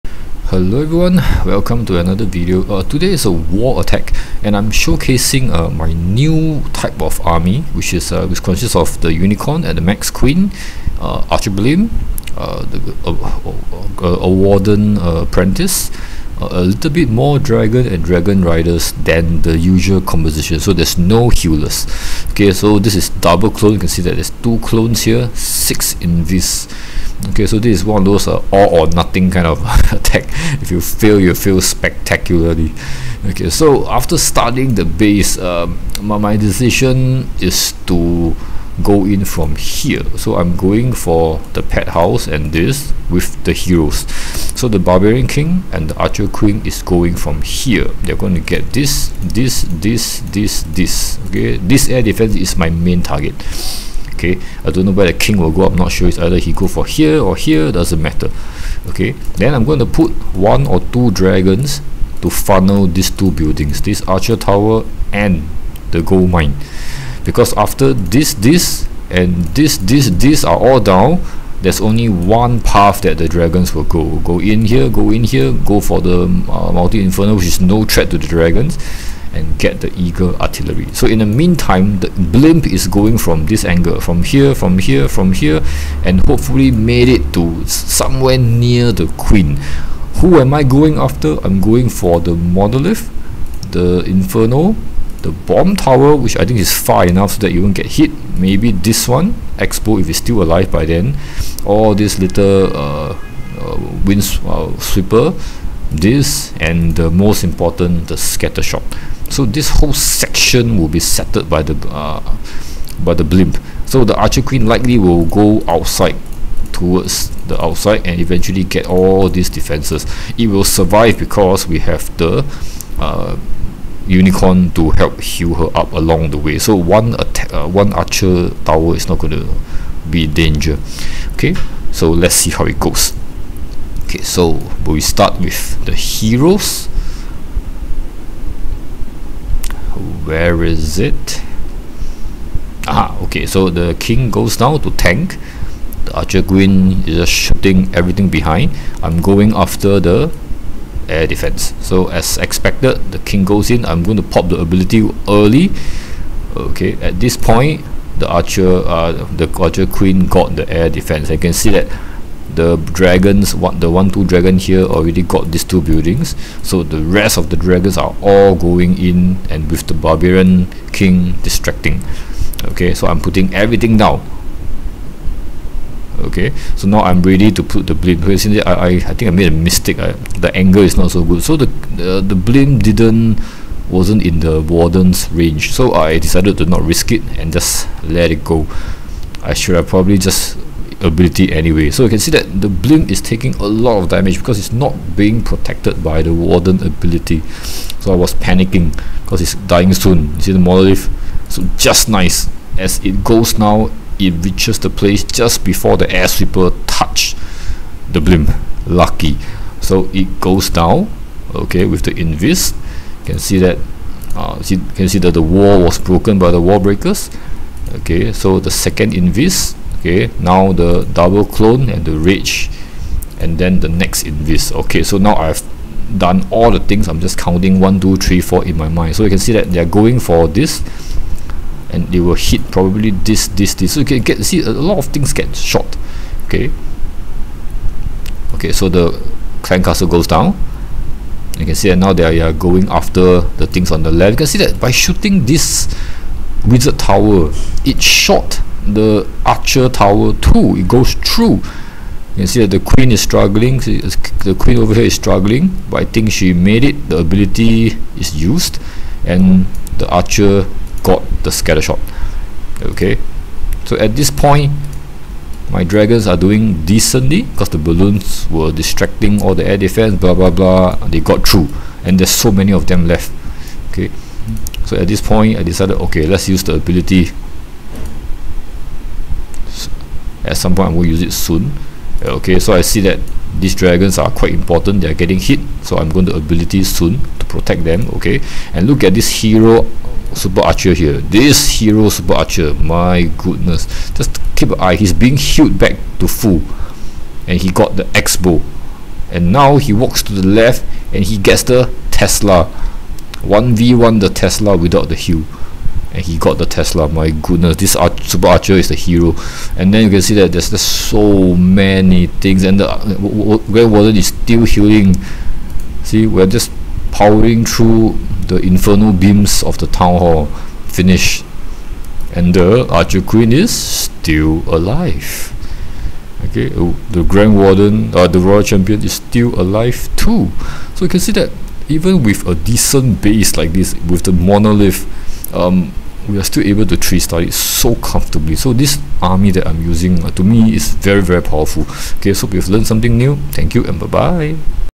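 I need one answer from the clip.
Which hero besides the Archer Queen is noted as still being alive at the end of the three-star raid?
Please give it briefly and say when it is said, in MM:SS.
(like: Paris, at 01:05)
Royal Champion, at 05:28.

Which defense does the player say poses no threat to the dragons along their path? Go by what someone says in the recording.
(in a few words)
Multi inferno.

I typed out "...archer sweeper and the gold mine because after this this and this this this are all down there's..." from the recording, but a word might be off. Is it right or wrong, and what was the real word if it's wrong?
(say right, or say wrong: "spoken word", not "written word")
wrong: "tower", not "sweeper".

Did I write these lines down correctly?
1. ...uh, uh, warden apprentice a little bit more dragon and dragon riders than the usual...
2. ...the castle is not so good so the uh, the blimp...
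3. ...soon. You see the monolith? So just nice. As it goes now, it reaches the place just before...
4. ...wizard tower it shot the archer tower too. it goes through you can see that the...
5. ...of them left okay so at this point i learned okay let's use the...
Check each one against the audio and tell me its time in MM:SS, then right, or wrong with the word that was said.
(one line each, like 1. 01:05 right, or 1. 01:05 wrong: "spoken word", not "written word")
1. 00:14 right
2. 03:00 wrong: "angle", not "castle"
3. 03:19 right
4. 04:06 right
5. 04:32 wrong: "decided", not "learned".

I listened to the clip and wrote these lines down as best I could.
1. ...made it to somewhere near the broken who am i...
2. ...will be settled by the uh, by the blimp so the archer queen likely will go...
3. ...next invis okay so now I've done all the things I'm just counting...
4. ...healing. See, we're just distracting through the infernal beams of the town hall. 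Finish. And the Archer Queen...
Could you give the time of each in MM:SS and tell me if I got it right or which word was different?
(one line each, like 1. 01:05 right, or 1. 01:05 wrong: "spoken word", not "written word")
1. 01:26 wrong: "queen", not "broken"
2. 01:50 right
3. 03:43 right
4. 05:14 wrong: "powering", not "distracting".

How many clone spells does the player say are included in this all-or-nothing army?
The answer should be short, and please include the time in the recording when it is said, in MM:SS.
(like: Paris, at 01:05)
2, at 00:24.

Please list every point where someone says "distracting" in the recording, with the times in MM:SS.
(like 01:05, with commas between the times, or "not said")
02:51, 04:28.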